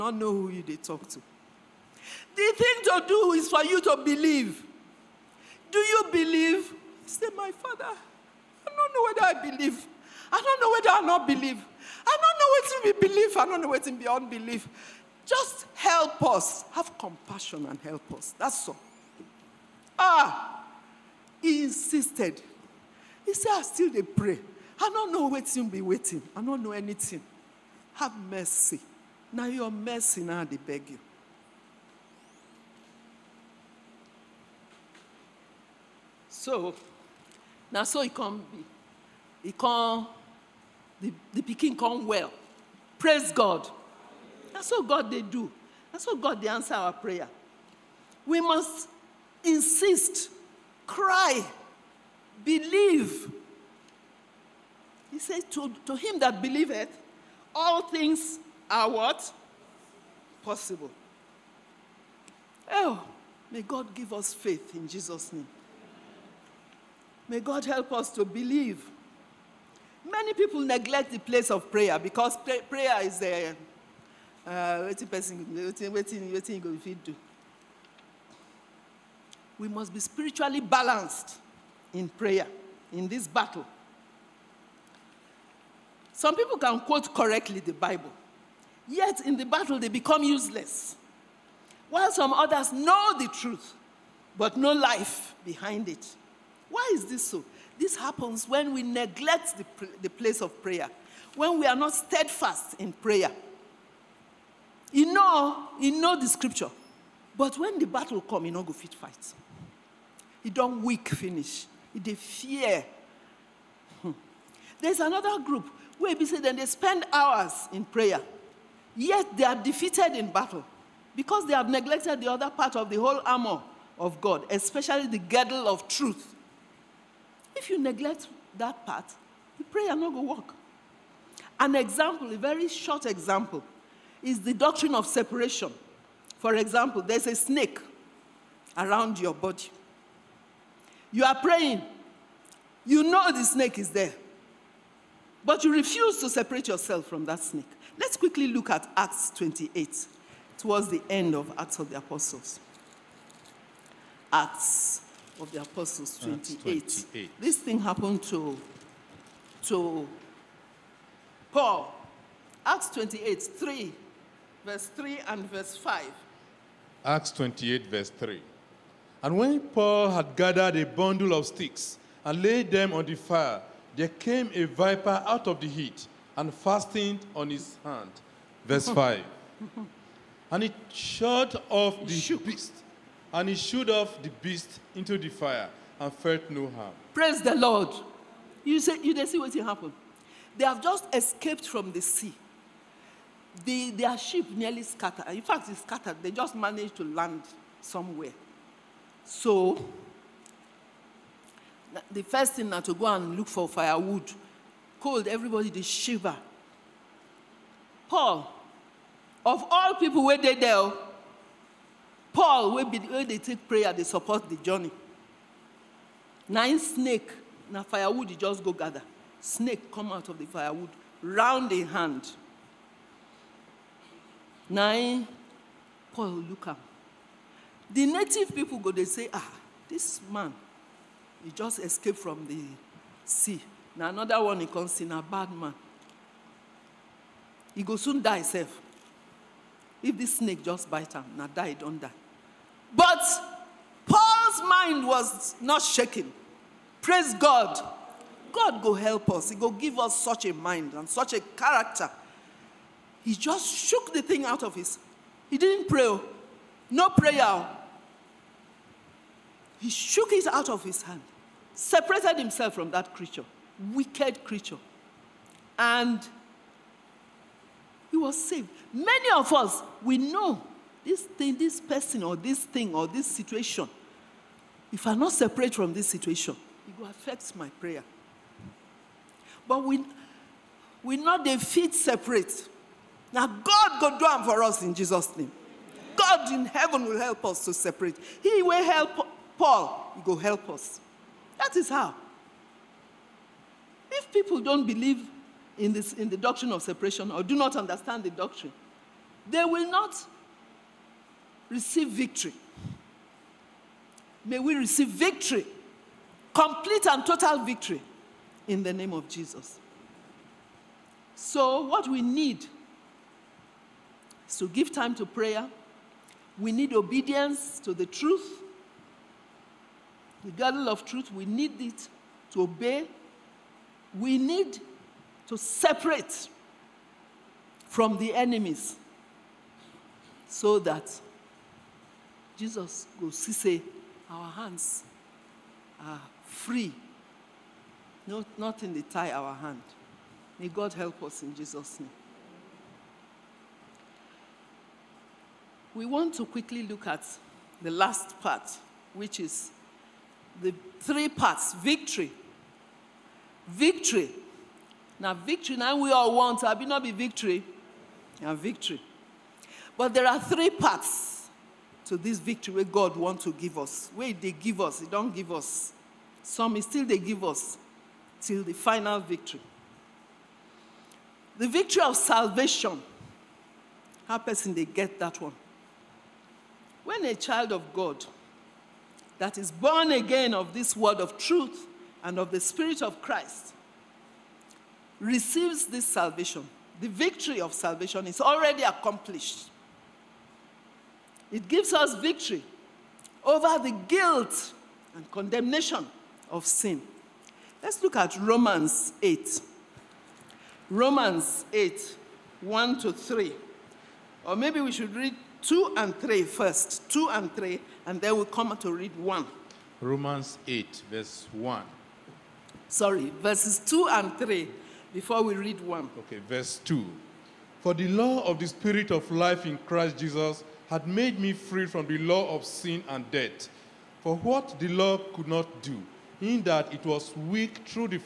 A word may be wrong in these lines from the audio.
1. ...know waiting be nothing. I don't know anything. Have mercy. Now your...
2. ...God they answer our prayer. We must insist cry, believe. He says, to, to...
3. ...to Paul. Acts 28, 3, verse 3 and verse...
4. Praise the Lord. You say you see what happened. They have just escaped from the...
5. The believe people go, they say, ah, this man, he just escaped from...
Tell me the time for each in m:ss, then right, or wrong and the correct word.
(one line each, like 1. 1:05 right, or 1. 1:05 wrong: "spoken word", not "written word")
1. 0:25 wrong: "waiting", not "nothing"
2. 0:46 right
3. 2:39 right
4. 3:07 right
5. 3:47 wrong: "native", not "believe".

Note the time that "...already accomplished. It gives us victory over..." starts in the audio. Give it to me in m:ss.
6:28.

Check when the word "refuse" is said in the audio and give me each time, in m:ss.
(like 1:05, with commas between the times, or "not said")
2:25.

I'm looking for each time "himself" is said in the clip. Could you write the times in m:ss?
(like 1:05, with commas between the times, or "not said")
3:58, 4:22.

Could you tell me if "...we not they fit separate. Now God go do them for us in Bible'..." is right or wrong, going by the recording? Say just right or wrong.
wrong.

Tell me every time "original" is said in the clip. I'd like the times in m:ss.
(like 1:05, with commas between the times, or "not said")
not said.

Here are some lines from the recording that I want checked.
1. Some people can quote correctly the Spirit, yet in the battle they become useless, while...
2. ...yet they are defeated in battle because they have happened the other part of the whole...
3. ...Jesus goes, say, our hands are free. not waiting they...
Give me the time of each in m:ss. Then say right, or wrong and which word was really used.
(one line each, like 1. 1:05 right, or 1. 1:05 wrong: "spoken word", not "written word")
1. 1:26 wrong: "Bible", not "Spirit"
2. 1:58 wrong: "neglected", not "happened"
3. 5:32 wrong: "nothing", not "waiting".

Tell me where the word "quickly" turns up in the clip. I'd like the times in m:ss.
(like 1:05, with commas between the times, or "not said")
2:28, 5:46.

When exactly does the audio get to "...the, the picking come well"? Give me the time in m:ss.
0:41.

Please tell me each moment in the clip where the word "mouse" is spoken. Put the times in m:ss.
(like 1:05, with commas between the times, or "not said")
not said.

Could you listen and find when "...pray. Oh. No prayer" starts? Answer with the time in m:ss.
4:15.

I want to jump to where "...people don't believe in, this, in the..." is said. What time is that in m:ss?
4:54.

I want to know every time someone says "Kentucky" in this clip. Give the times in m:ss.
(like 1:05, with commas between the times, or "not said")
not said.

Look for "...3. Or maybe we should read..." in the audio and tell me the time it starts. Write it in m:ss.
6:43.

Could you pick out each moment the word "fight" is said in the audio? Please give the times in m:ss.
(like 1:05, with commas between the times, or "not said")
1:48.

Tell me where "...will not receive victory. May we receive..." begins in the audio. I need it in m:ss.
4:59.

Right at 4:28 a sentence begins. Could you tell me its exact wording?
Many of us, we know this thing, this person, or this thing, or this situation.